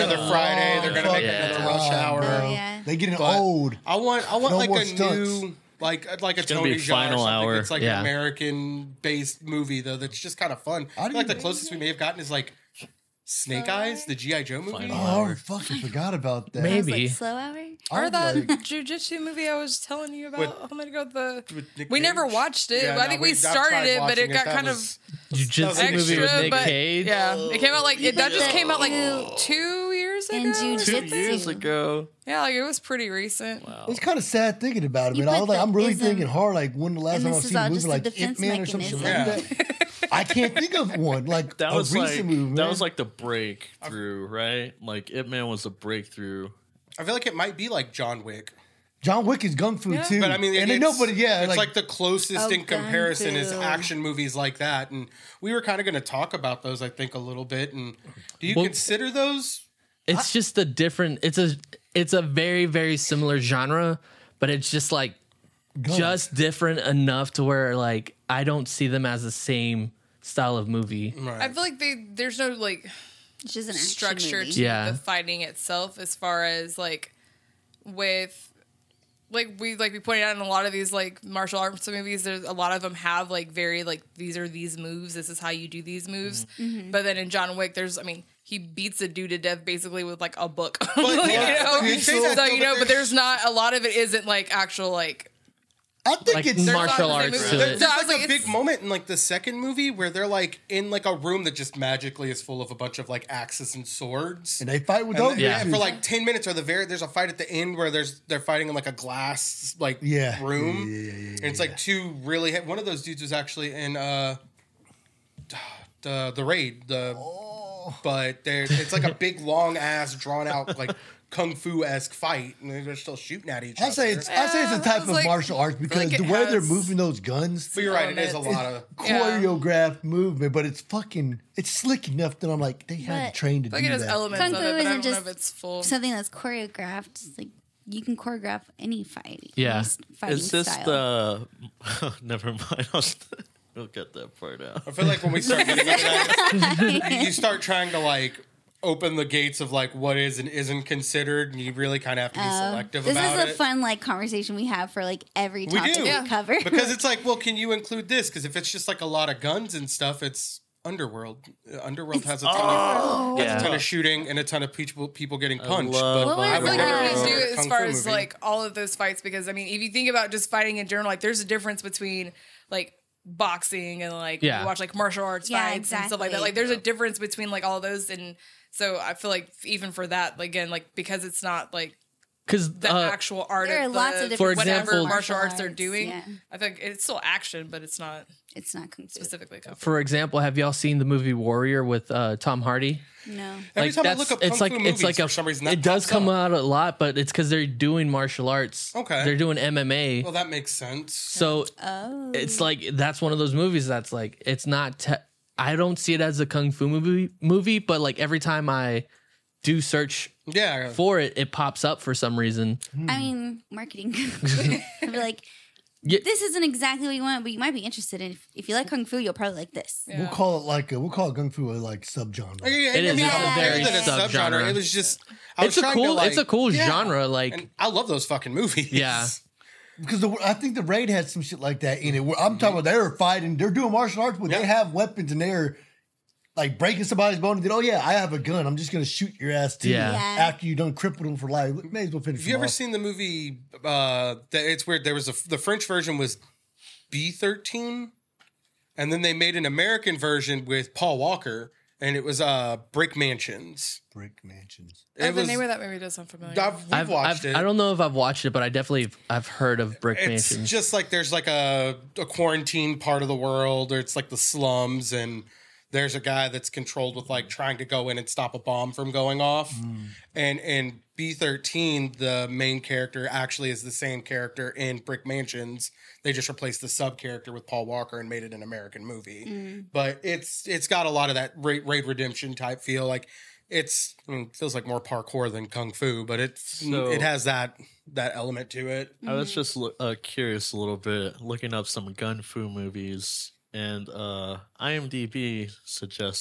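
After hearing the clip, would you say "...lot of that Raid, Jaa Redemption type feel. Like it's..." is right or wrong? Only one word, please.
wrong.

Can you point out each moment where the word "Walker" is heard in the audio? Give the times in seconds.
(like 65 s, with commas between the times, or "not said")
251 s, 277 s.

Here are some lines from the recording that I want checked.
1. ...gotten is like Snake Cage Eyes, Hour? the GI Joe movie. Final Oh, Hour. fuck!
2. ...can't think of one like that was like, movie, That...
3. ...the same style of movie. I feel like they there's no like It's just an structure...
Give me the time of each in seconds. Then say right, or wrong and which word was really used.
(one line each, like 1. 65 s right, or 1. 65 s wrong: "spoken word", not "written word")
1. 11 s wrong: "Slow", not "Cage"
2. 40 s right
3. 69 s right.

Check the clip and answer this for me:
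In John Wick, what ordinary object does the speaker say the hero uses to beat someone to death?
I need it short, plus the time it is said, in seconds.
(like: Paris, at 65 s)
A book, at 90 s.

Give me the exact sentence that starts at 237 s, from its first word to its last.
And then, oh yeah, I have a gun.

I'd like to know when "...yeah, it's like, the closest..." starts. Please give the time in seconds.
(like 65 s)
51 s.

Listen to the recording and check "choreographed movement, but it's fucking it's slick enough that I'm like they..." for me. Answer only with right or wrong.
right.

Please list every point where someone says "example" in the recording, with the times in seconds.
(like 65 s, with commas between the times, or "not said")
184 s, 189 s.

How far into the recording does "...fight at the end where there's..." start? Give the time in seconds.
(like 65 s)
107 s.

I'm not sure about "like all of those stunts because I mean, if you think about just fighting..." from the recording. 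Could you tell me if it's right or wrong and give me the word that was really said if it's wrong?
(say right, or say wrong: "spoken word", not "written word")
wrong: "fights", not "stunts".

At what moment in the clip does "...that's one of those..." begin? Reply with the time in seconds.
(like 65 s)
202 s.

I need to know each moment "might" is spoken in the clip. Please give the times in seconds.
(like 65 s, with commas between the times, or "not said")
47 s, 217 s.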